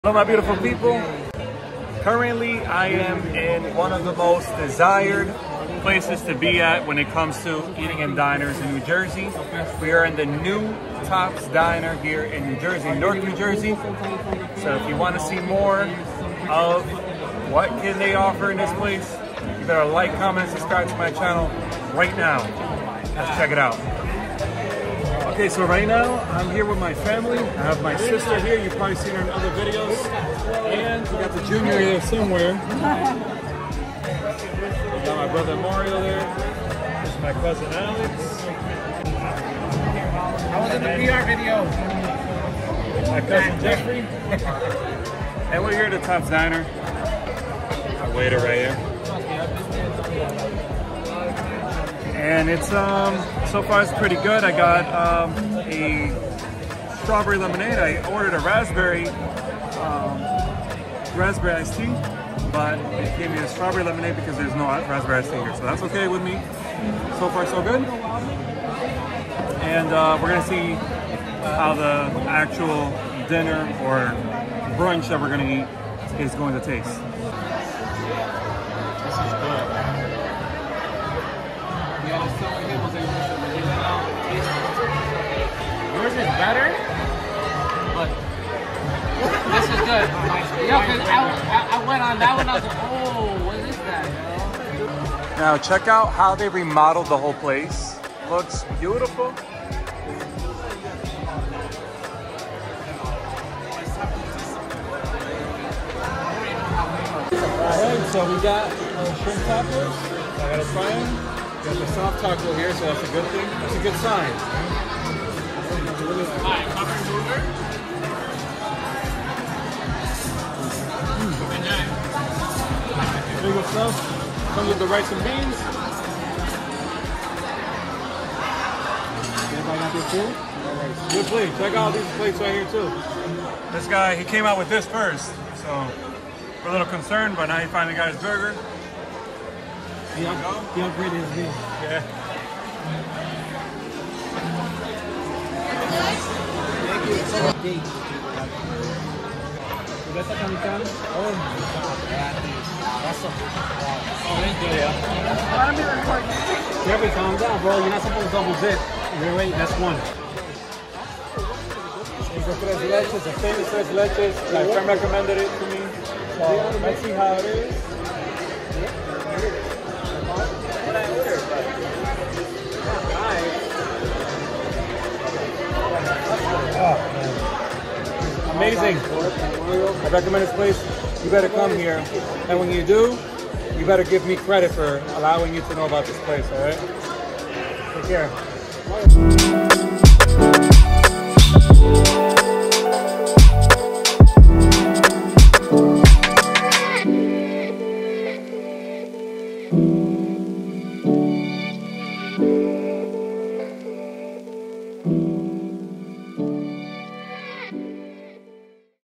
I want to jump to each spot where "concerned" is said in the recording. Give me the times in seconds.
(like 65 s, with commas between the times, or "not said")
136 s.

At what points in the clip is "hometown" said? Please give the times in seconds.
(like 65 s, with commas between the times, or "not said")
not said.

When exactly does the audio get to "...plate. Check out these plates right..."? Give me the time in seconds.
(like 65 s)
131 s.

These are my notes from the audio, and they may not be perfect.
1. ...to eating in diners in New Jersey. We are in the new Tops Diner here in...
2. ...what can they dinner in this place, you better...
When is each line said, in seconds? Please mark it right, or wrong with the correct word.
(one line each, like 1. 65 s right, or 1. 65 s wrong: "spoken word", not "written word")
1. 7 s right
2. 17 s wrong: "offer", not "dinner".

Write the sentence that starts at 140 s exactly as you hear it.
He, up, he upgraded his meal.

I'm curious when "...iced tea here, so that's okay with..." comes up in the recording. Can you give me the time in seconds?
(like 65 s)
65 s.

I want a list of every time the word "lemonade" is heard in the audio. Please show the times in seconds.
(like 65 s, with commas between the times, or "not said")
57 s, 63 s.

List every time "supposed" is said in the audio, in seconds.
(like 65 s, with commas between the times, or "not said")
158 s.